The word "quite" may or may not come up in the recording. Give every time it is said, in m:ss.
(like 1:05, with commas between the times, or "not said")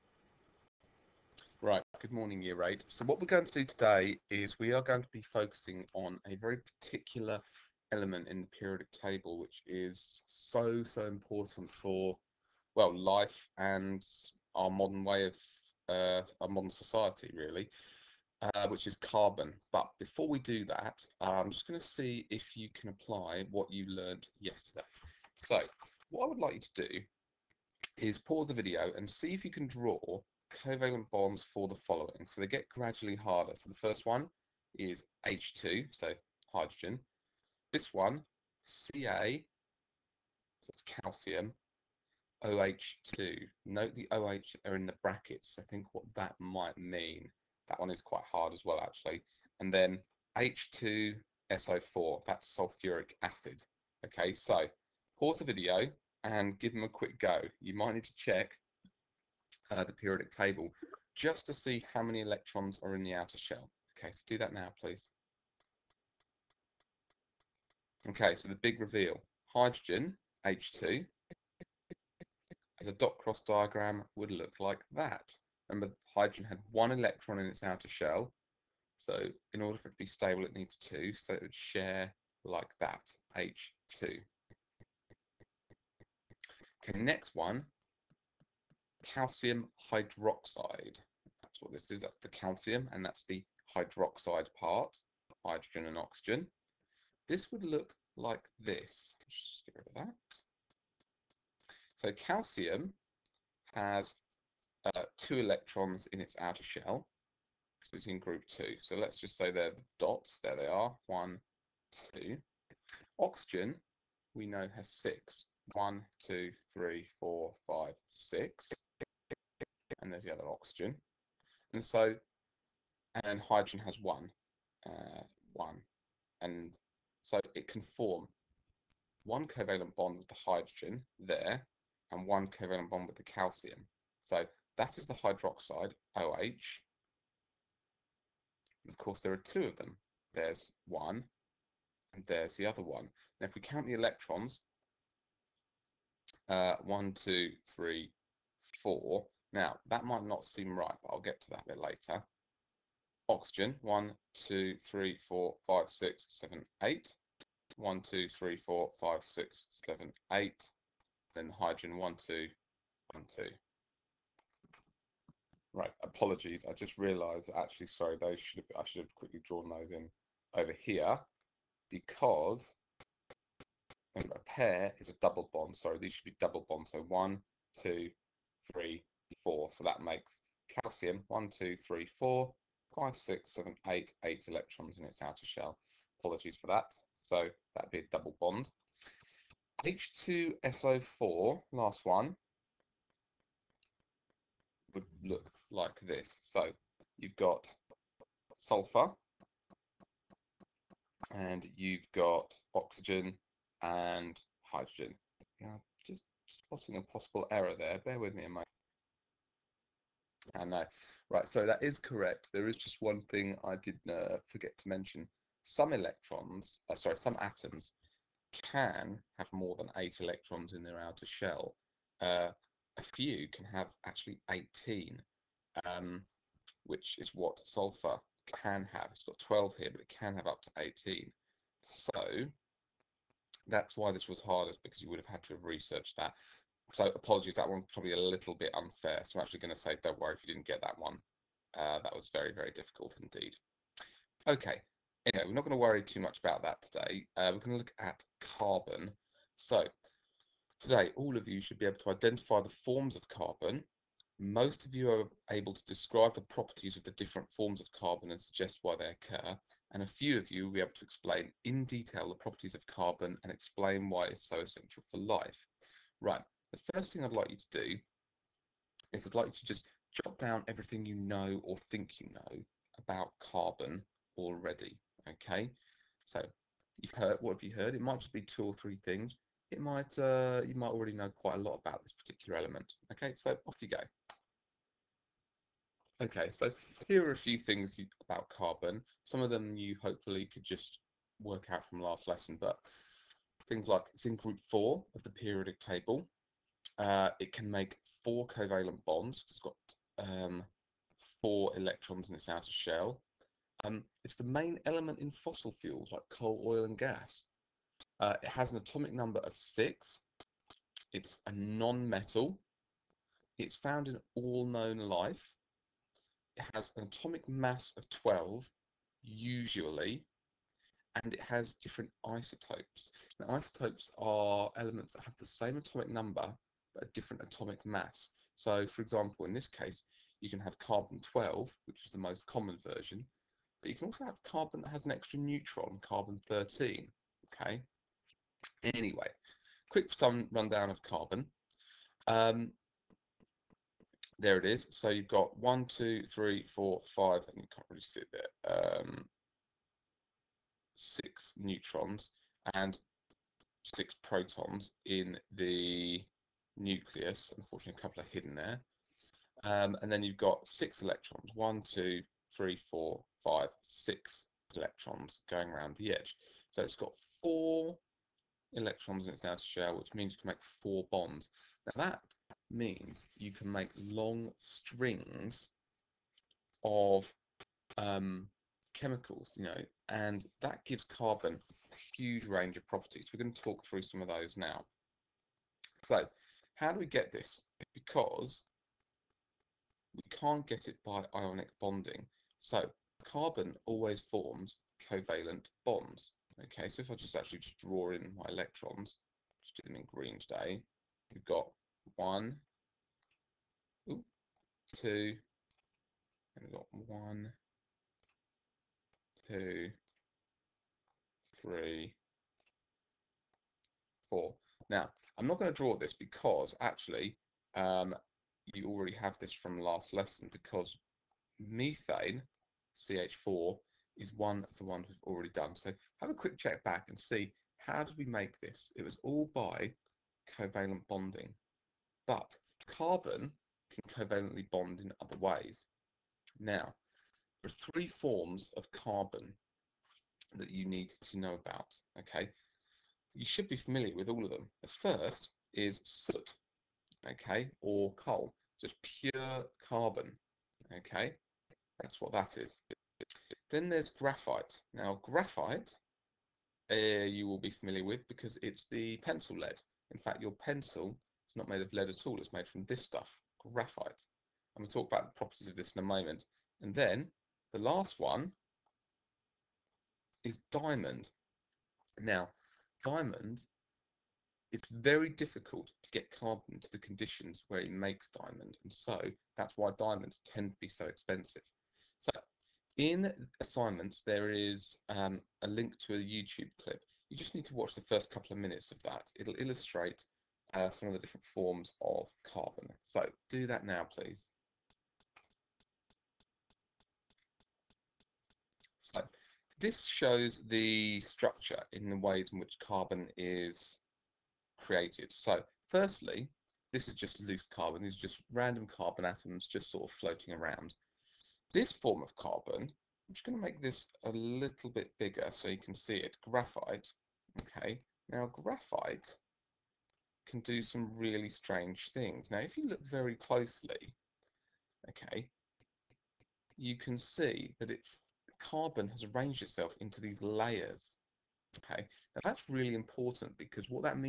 0:48, 4:41.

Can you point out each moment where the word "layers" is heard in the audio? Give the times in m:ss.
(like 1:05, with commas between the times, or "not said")
8:50.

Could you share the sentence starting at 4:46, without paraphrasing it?
Okay, so here are a few things you, about carbon.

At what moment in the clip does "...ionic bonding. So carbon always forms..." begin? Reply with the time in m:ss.
6:31.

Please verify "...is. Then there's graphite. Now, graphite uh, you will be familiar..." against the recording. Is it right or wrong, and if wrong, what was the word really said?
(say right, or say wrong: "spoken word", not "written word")
right.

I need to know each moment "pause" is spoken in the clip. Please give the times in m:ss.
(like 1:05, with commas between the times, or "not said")
0:28, 0:55.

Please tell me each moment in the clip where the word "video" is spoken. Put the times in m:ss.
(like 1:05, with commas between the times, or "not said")
0:28, 0:55.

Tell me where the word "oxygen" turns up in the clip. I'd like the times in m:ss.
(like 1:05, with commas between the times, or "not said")
1:35, 1:53, 2:00, 2:33, 3:22.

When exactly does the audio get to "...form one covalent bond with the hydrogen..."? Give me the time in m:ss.
2:07.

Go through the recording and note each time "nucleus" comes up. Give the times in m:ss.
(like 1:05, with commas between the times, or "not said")
5:56.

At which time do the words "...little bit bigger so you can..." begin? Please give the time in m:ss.
8:34.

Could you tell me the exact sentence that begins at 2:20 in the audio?
There's one and there's the other one.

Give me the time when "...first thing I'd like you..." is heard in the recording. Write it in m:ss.
4:26.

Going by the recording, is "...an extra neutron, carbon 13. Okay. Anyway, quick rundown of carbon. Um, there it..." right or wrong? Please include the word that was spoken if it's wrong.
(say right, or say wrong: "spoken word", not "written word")
right.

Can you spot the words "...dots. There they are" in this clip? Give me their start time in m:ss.
1:49.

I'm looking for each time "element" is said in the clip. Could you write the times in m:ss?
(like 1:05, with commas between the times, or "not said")
0:07, 4:42, 5:04, 5:24.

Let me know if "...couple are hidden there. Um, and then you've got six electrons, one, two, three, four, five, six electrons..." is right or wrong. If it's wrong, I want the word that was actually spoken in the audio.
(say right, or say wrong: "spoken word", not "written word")
right.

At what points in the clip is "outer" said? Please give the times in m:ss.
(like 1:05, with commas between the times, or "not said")
1:03, 1:17, 1:46, 3:05, 3:40, 5:02, 6:09.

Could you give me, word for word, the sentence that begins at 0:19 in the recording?
But before we do that, I'm just going to see if you can apply what you learned yesterday.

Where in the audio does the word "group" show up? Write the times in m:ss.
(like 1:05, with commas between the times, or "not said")
1:48, 4:54.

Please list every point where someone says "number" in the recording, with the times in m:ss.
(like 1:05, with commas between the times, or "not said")
5:09, 5:26.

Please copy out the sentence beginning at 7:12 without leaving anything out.
But carbon can covalently bond in other ways.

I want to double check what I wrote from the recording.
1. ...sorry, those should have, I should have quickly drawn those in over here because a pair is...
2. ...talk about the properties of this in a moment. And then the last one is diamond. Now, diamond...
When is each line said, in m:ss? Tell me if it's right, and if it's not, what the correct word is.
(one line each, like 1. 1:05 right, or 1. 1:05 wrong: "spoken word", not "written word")
1. 2:47 right
2. 7:44 right.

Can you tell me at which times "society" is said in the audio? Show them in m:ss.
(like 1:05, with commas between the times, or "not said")
0:16.